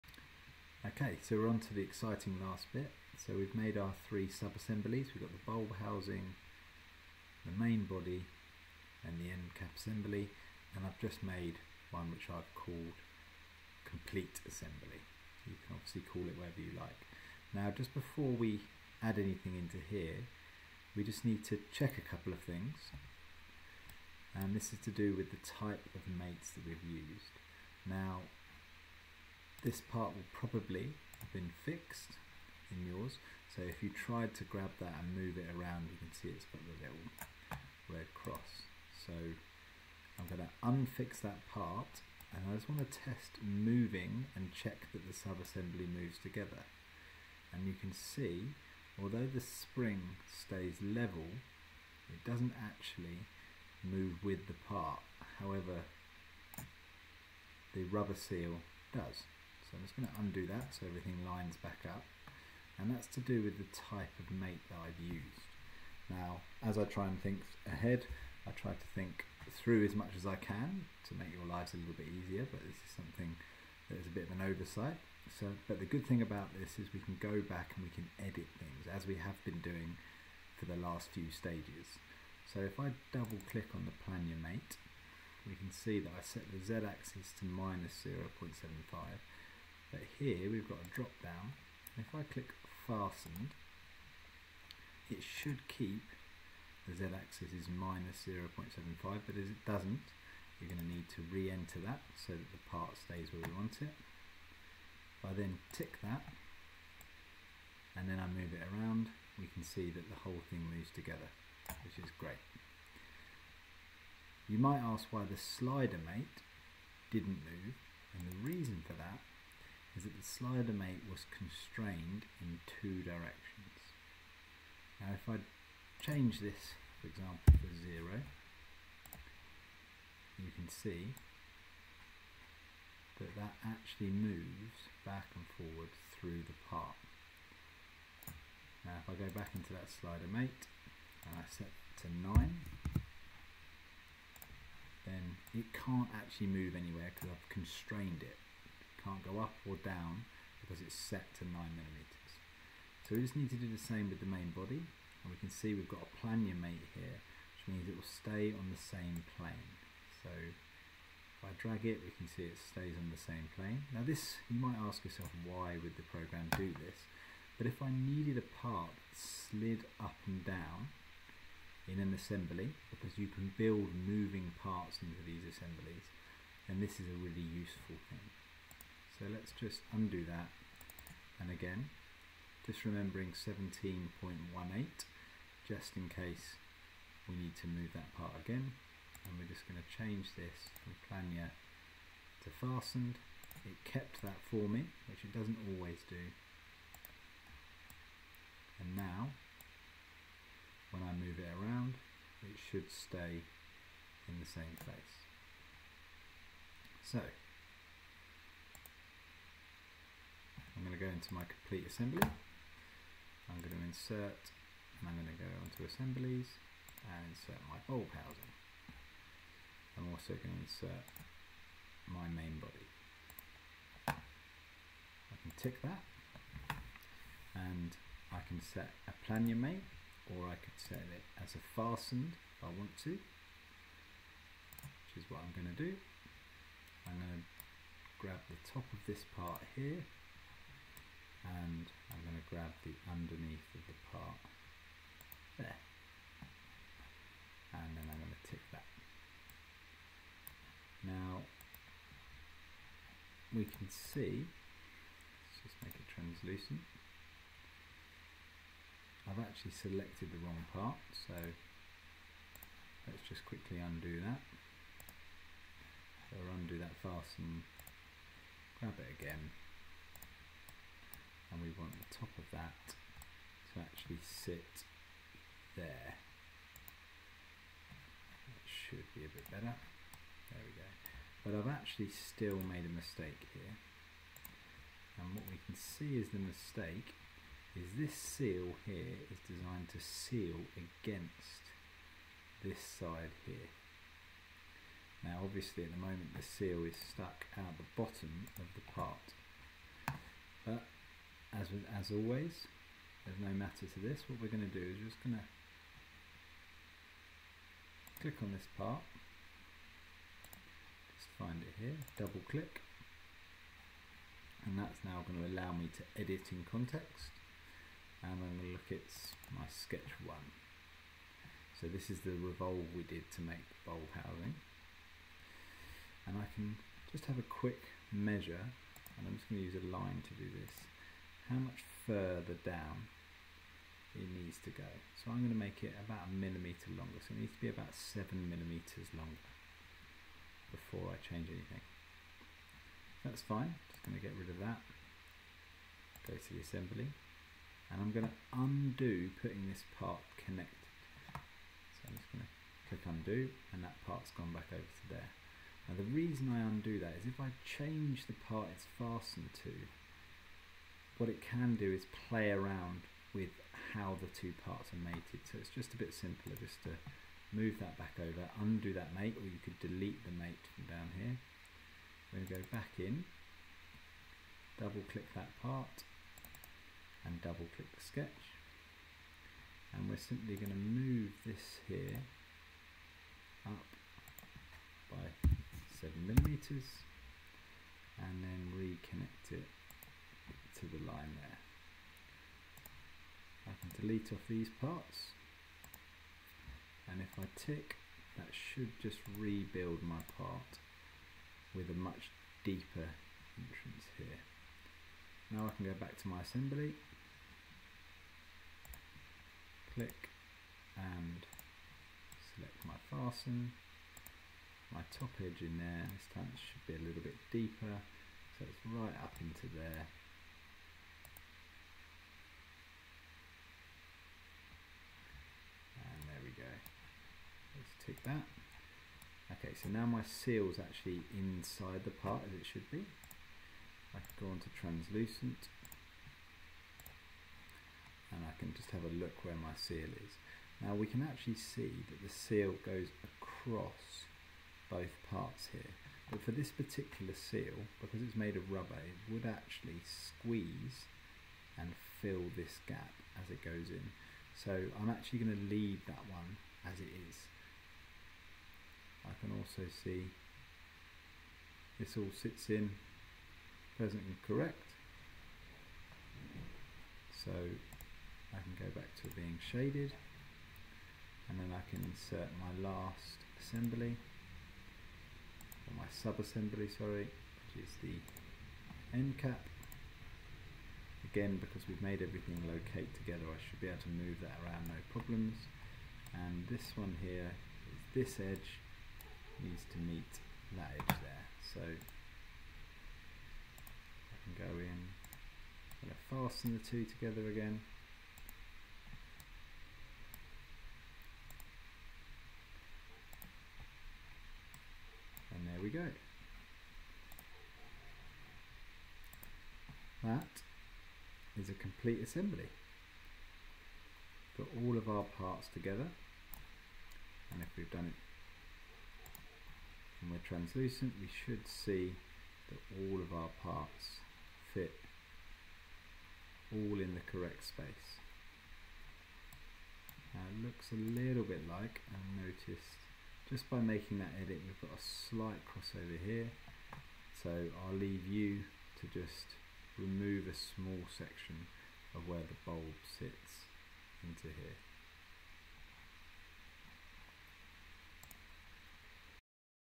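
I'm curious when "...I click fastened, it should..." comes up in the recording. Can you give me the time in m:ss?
1:32.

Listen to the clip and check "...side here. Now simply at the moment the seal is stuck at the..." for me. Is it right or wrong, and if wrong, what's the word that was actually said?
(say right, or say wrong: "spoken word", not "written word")
wrong: "obviously", not "simply".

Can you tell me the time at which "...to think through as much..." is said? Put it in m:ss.
1:08.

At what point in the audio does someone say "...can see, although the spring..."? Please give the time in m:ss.
0:47.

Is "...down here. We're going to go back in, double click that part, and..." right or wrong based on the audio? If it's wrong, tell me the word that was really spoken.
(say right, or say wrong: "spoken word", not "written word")
right.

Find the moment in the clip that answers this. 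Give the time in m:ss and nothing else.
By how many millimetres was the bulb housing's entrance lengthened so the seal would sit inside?
5:37.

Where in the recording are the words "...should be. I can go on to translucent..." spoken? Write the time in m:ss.
7:12.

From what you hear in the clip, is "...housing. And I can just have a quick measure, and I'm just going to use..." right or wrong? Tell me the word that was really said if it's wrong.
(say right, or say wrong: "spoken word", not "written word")
right.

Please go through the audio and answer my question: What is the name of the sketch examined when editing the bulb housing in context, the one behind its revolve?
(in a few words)
sketch one.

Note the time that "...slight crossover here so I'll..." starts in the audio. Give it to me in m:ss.
8:55.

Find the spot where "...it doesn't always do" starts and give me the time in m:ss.
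3:15.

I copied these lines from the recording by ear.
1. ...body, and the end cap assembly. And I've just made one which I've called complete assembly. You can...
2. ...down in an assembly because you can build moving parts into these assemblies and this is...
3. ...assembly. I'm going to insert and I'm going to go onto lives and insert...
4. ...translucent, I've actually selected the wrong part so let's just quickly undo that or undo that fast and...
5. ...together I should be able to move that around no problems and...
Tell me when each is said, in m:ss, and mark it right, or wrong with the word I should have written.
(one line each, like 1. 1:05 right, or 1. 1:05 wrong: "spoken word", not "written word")
1. 0:07 right
2. 2:50 right
3. 3:31 wrong: "assemblies", not "lives"
4. 4:16 right
5. 8:03 right.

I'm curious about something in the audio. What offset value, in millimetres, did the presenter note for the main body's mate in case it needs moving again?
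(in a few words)
17.18.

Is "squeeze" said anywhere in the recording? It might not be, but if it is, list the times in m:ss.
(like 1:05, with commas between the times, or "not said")
7:30.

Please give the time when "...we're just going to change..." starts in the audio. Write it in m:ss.
3:09.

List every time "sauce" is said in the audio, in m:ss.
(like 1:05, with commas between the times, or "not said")
not said.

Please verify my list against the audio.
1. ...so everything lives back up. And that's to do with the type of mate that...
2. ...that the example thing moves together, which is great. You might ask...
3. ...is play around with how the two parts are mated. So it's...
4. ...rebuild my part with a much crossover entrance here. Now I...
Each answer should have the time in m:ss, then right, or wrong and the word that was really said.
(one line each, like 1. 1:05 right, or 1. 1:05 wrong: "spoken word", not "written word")
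1. 1:00 wrong: "lines", not "lives"
2. 1:49 wrong: "whole", not "example"
3. 6:01 right
4. 6:39 wrong: "deeper", not "crossover".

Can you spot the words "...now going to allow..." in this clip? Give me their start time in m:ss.
5:15.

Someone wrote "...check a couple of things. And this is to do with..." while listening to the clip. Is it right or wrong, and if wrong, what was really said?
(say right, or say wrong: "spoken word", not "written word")
right.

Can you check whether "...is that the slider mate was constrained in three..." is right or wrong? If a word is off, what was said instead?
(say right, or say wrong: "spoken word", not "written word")
wrong: "two", not "three".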